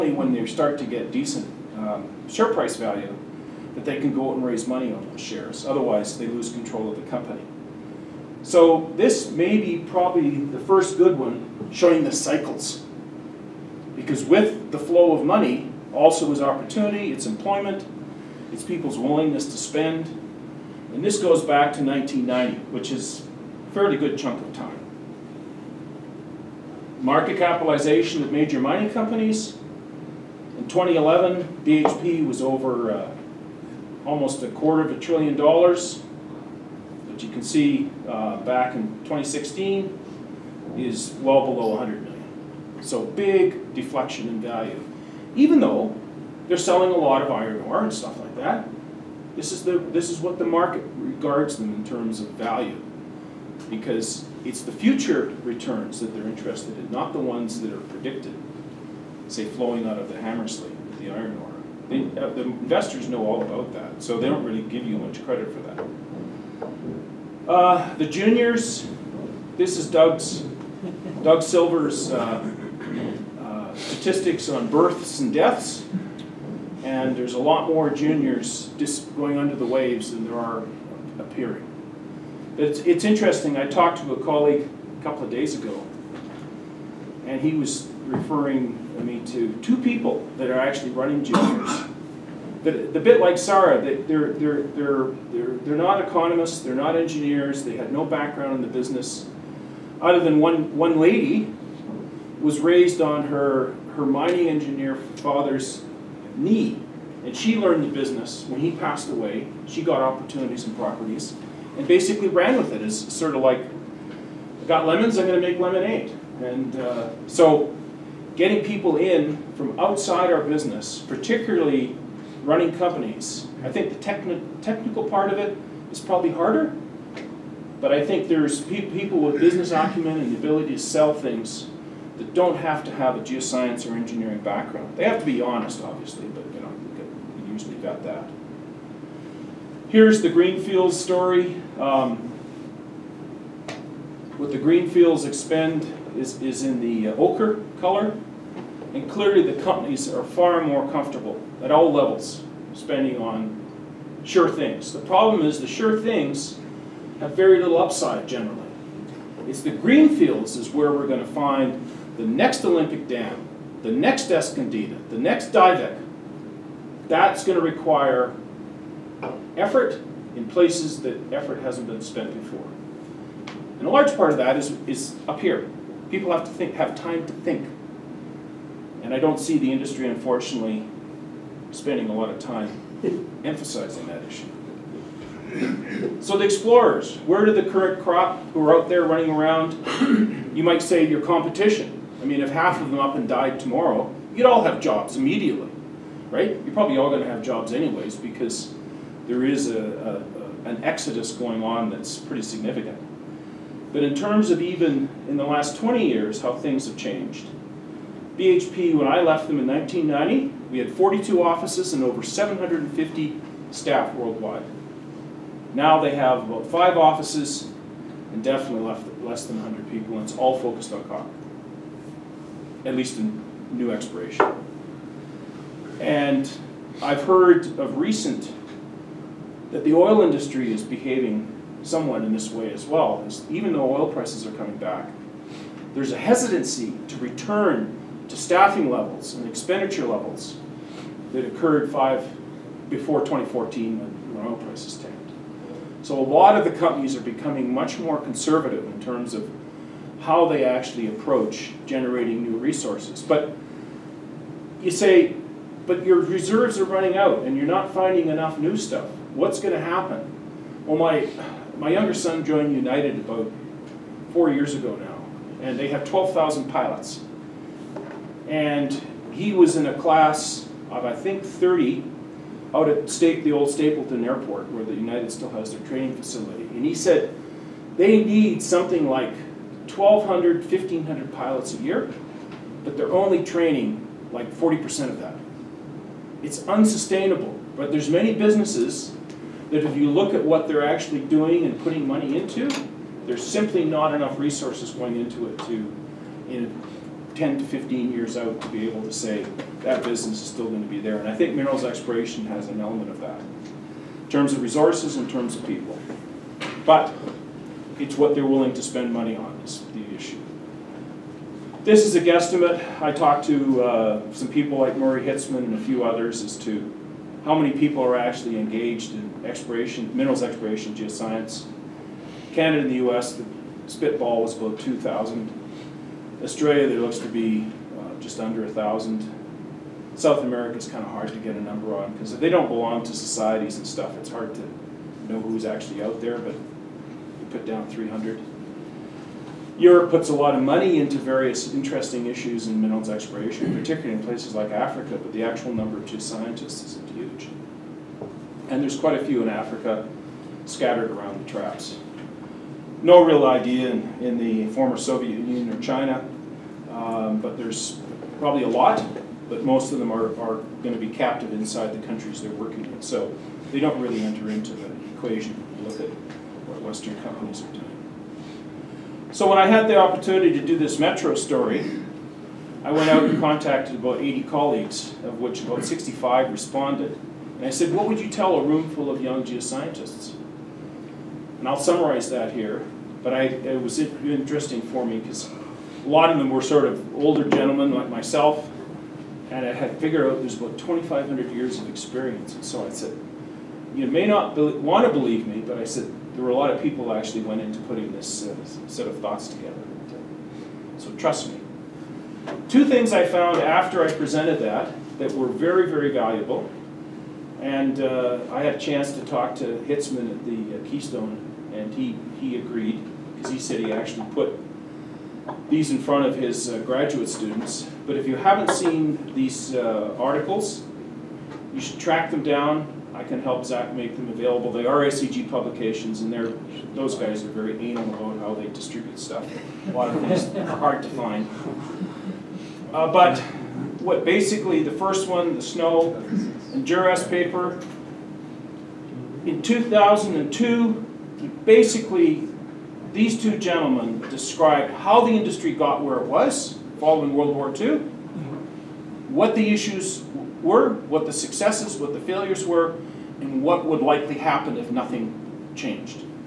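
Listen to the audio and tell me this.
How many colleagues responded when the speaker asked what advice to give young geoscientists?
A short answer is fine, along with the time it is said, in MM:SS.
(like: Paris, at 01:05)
about 65, at 06:15.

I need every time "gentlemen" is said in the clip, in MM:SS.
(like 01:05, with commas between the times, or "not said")
06:27, 07:23.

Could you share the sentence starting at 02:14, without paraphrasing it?
They have to be honest, obviously, but you know, you usually got that.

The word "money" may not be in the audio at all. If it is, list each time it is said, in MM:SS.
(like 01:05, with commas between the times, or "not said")
00:04, 00:15, 04:52, 05:09, 05:40.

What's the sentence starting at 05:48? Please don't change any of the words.
And there's quite a few in Africa scattered around the traps.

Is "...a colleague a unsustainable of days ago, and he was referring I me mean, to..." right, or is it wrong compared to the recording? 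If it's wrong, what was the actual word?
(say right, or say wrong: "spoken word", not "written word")
wrong: "couple", not "unsustainable".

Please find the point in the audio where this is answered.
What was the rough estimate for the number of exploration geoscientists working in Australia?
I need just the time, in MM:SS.
05:28.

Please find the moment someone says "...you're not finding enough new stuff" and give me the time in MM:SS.
04:17.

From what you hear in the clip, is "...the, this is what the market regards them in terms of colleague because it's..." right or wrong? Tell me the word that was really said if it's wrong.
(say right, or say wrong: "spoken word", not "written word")
wrong: "value", not "colleague".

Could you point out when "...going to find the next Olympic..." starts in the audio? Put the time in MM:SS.
02:41.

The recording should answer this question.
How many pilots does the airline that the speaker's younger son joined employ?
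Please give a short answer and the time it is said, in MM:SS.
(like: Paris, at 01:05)
12,000, at 04:26.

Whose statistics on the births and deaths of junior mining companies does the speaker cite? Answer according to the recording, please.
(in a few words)
Doug Silver.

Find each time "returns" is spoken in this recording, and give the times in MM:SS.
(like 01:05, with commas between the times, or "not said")
00:55, 03:57.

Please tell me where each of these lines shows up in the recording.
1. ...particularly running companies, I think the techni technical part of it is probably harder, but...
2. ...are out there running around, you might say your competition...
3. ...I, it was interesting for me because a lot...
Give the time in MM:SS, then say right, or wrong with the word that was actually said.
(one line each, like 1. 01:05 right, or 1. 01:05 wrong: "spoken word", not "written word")
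1. 02:01 right
2. 03:08 right
3. 06:23 right.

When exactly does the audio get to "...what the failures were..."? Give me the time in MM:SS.
07:32.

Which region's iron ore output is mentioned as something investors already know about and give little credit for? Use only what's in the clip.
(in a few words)
Hamersley.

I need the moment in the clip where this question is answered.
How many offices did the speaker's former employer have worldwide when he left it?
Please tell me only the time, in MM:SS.
03:30.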